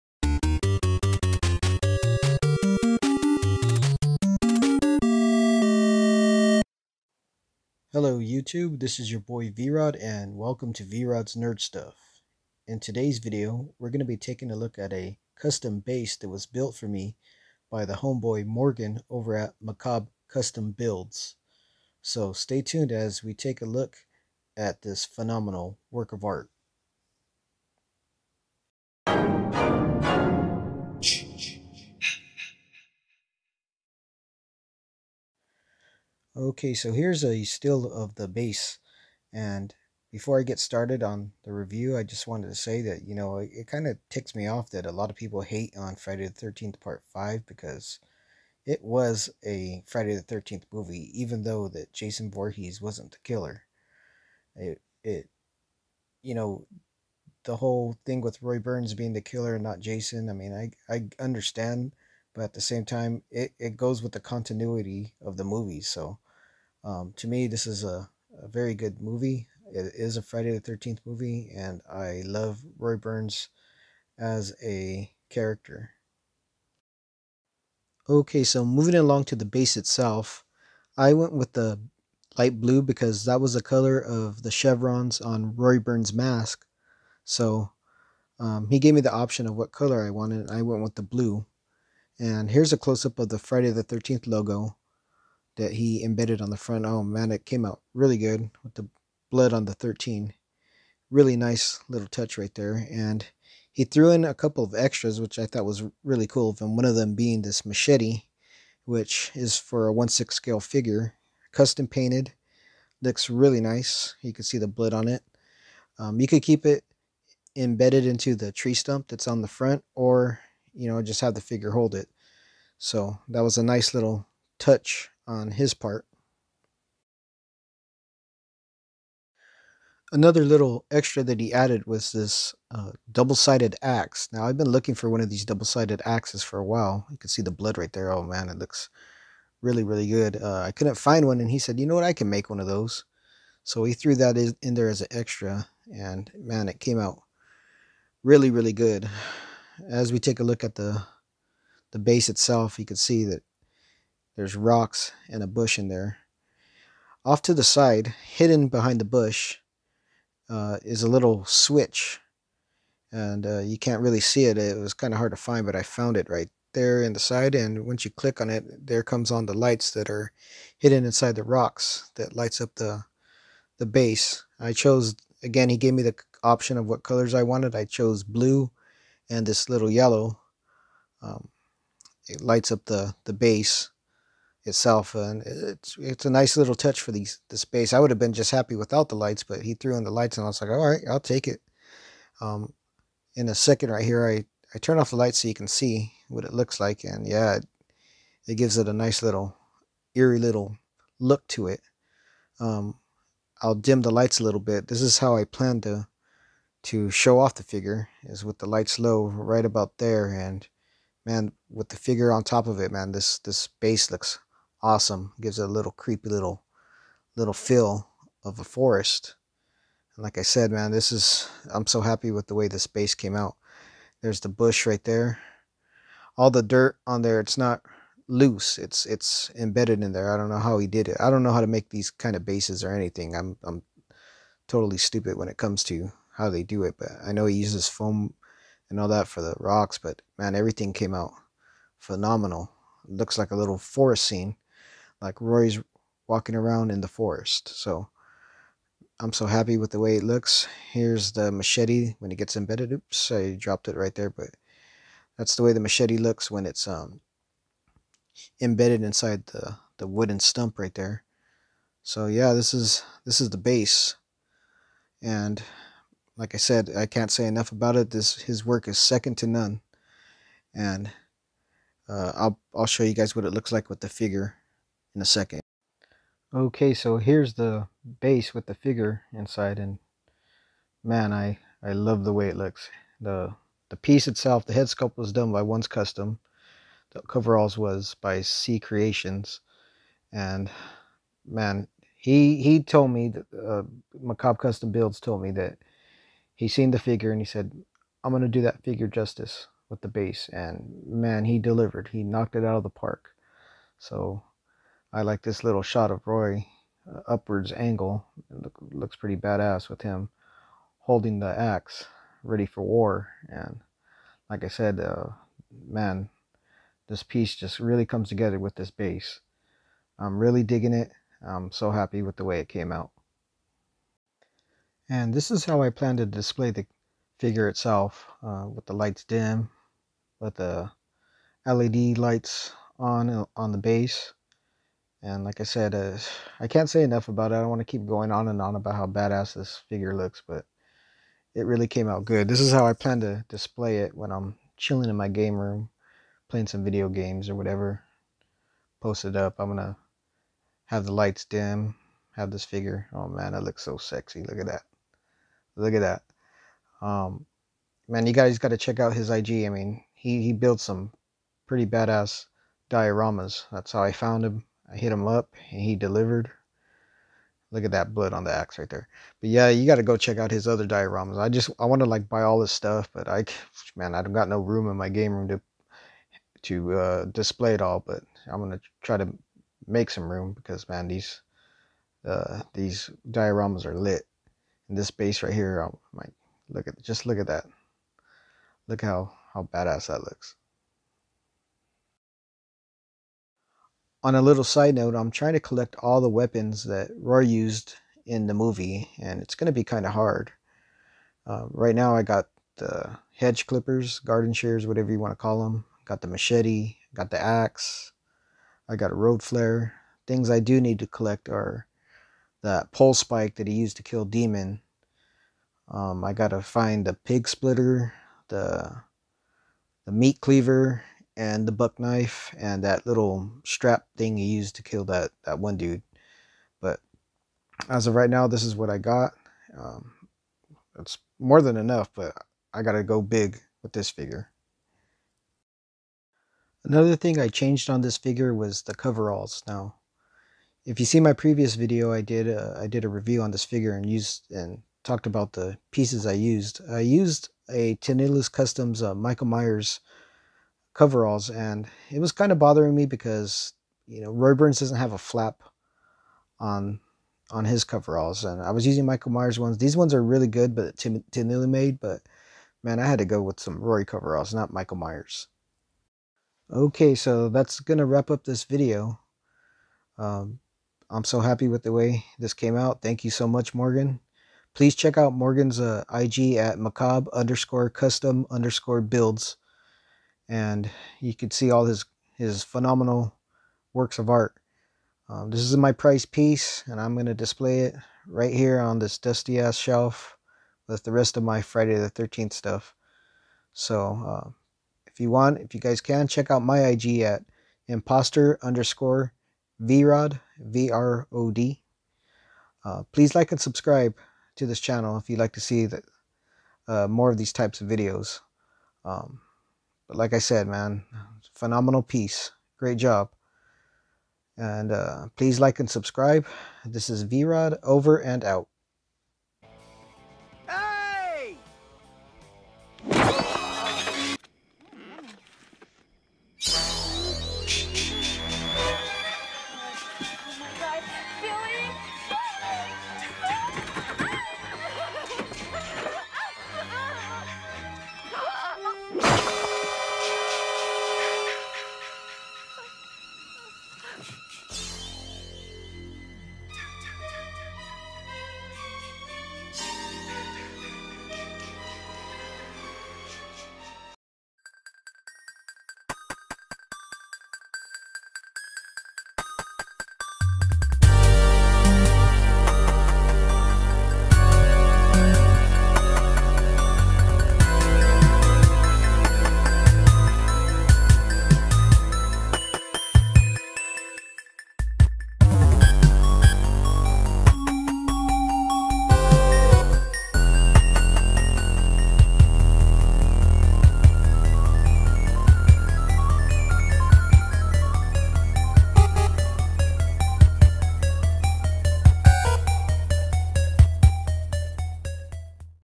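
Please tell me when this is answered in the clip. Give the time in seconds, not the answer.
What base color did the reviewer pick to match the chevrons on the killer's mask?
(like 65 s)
82 s.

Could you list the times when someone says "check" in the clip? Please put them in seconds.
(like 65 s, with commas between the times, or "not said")
358 s, 370 s, 474 s, 496 s.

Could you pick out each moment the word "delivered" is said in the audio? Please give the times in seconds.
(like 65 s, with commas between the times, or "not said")
301 s, 365 s.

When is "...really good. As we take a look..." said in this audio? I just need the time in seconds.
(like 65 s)
148 s.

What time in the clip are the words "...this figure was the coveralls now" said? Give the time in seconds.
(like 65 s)
438 s.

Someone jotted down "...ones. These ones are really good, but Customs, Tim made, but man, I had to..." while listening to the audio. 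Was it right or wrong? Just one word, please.
wrong.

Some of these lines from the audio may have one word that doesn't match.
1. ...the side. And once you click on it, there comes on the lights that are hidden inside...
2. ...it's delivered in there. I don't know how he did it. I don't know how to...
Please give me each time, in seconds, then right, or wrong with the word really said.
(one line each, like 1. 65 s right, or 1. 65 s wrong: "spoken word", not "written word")
1. 167 s right
2. 229 s wrong: "embedded", not "delivered".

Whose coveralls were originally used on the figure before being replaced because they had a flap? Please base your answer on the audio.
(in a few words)
Tenilus Customs.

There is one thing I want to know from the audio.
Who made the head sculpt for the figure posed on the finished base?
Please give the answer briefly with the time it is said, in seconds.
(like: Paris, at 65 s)
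Once Custom, at 285 s.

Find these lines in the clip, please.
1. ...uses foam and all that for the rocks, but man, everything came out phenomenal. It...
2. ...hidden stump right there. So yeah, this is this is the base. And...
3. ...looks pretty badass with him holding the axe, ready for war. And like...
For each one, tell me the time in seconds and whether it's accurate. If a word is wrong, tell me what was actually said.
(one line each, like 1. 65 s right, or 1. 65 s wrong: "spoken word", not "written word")
1. 237 s right
2. 260 s wrong: "wooden", not "hidden"
3. 308 s right.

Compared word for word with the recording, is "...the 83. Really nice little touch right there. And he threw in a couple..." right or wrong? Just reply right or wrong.
wrong.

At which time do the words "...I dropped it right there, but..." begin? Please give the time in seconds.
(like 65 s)
253 s.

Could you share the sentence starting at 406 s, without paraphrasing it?
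Got the machete, got the axe, I got a road flare.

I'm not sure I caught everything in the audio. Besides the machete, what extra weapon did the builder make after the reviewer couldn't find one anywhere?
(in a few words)
double sided axe.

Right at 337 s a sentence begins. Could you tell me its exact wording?
I don't want to keep going on and on about how badass this figure looks, but it really came out good.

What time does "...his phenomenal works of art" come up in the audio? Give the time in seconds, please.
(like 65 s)
482 s.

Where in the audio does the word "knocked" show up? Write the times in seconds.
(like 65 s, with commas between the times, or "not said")
302 s.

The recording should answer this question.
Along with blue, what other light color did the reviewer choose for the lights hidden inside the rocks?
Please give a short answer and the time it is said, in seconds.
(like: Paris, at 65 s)
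yellow, at 179 s.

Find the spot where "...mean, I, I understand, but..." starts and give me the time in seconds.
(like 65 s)
60 s.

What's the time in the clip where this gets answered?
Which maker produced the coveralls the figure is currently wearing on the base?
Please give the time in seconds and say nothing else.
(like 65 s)
288 s.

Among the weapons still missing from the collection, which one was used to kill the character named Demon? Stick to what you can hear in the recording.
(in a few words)
pole spike.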